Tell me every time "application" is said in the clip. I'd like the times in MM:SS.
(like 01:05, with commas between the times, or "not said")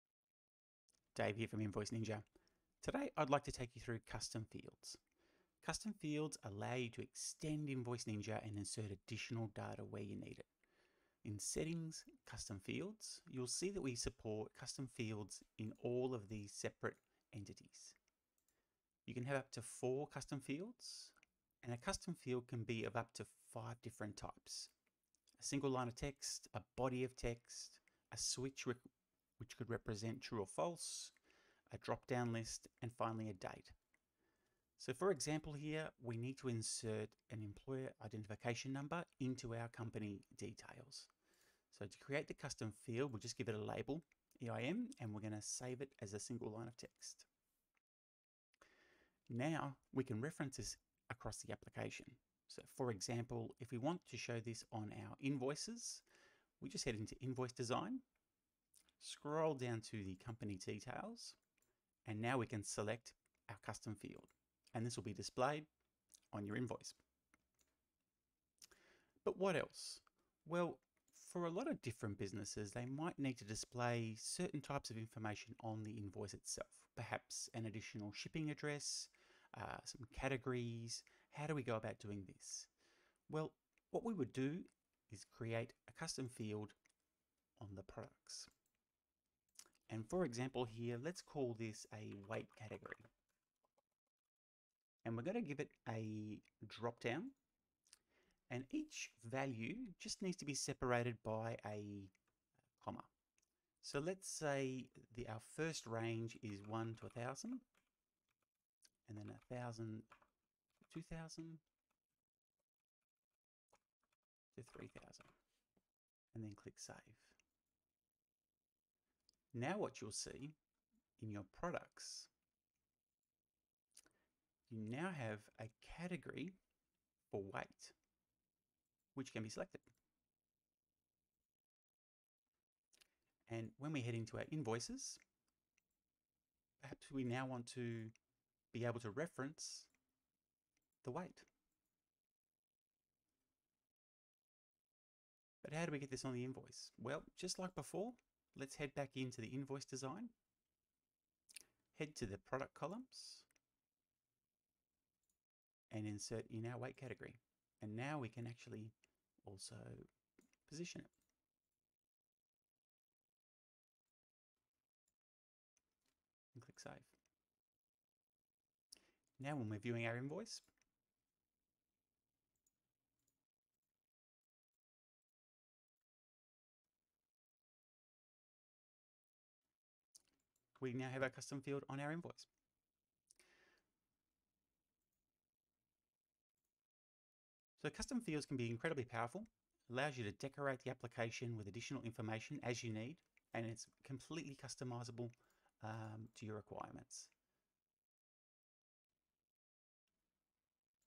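00:51, 03:10.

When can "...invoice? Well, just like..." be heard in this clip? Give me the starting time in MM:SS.
02:26.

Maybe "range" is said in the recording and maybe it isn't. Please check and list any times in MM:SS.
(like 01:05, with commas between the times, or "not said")
01:45.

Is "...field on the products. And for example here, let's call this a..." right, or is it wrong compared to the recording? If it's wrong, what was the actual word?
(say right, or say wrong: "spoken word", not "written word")
right.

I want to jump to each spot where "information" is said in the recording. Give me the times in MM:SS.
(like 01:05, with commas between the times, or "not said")
01:14, 03:12.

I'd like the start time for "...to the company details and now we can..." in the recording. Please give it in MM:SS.
00:59.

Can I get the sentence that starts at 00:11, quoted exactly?
In Settings, Custom Fields, you'll see that we support custom fields in all of these separate entities.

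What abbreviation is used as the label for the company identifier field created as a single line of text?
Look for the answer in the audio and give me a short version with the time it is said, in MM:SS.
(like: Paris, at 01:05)
EIN, at 00:44.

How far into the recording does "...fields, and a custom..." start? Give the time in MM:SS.
00:20.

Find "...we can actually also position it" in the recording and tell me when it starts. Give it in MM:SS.
02:38.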